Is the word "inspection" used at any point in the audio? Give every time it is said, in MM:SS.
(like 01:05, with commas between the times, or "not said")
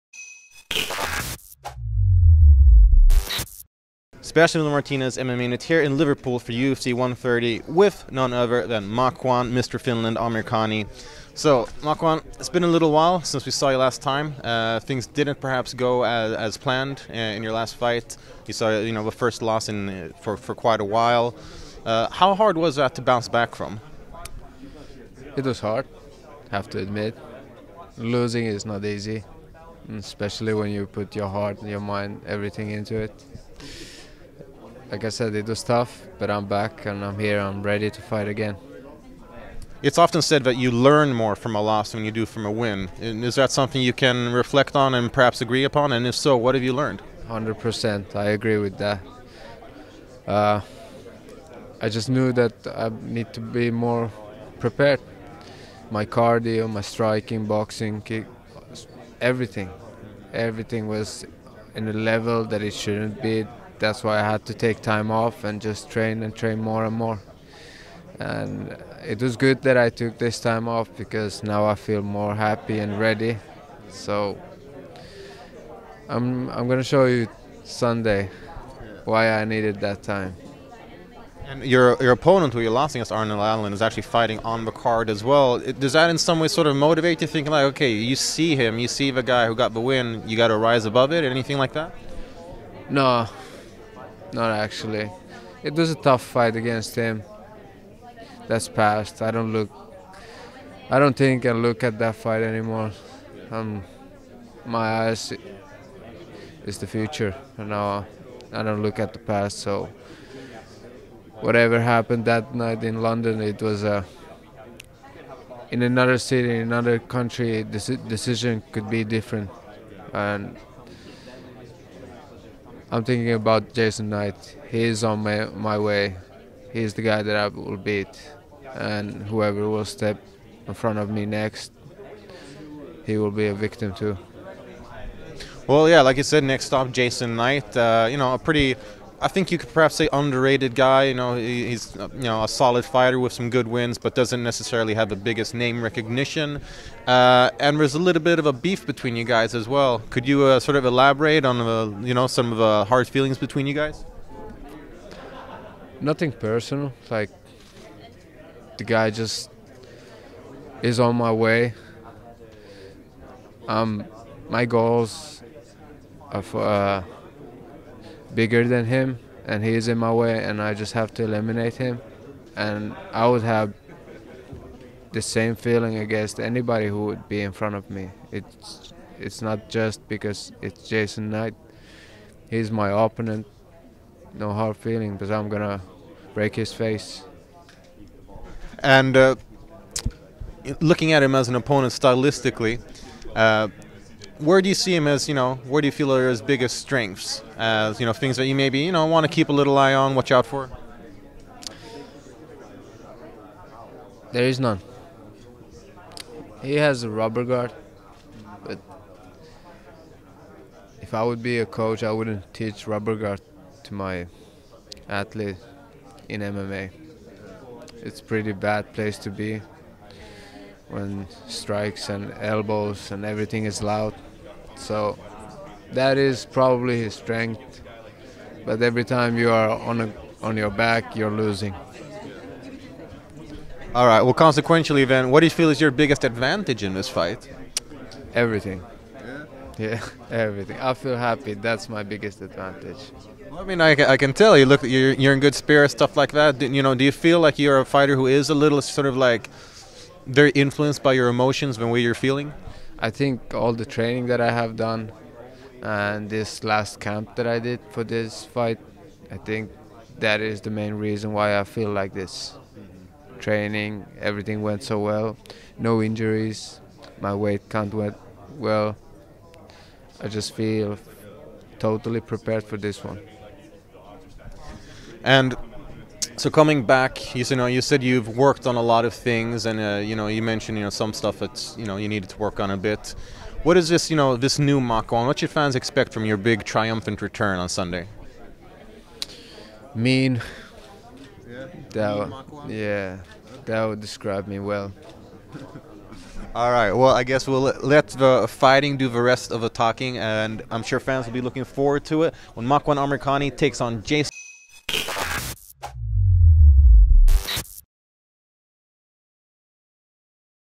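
not said.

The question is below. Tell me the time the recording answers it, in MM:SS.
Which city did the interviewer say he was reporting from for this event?
00:05.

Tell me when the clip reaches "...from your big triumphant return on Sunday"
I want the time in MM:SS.
04:46.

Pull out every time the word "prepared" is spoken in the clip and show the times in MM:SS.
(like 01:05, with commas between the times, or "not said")
00:54, 04:32.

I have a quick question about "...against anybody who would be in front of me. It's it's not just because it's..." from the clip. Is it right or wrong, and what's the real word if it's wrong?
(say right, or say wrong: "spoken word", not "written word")
right.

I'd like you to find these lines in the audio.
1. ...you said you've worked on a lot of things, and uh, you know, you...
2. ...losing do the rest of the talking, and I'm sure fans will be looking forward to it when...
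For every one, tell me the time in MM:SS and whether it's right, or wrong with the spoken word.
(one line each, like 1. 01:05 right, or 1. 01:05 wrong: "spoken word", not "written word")
1. 04:37 right
2. 04:58 wrong: "fighting", not "losing".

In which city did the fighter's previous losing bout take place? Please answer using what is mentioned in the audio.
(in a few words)
London.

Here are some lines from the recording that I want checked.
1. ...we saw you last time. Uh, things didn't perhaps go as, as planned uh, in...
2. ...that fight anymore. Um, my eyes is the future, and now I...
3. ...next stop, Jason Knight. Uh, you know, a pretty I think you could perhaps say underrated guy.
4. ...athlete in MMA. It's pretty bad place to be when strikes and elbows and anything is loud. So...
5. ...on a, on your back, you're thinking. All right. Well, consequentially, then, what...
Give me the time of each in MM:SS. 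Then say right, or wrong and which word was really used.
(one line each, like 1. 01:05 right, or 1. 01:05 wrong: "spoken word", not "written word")
1. 00:13 right
2. 01:41 right
3. 02:16 right
4. 03:35 wrong: "everything", not "anything"
5. 03:49 wrong: "losing", not "thinking".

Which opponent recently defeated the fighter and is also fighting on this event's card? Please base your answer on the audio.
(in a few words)
Arnold Allen.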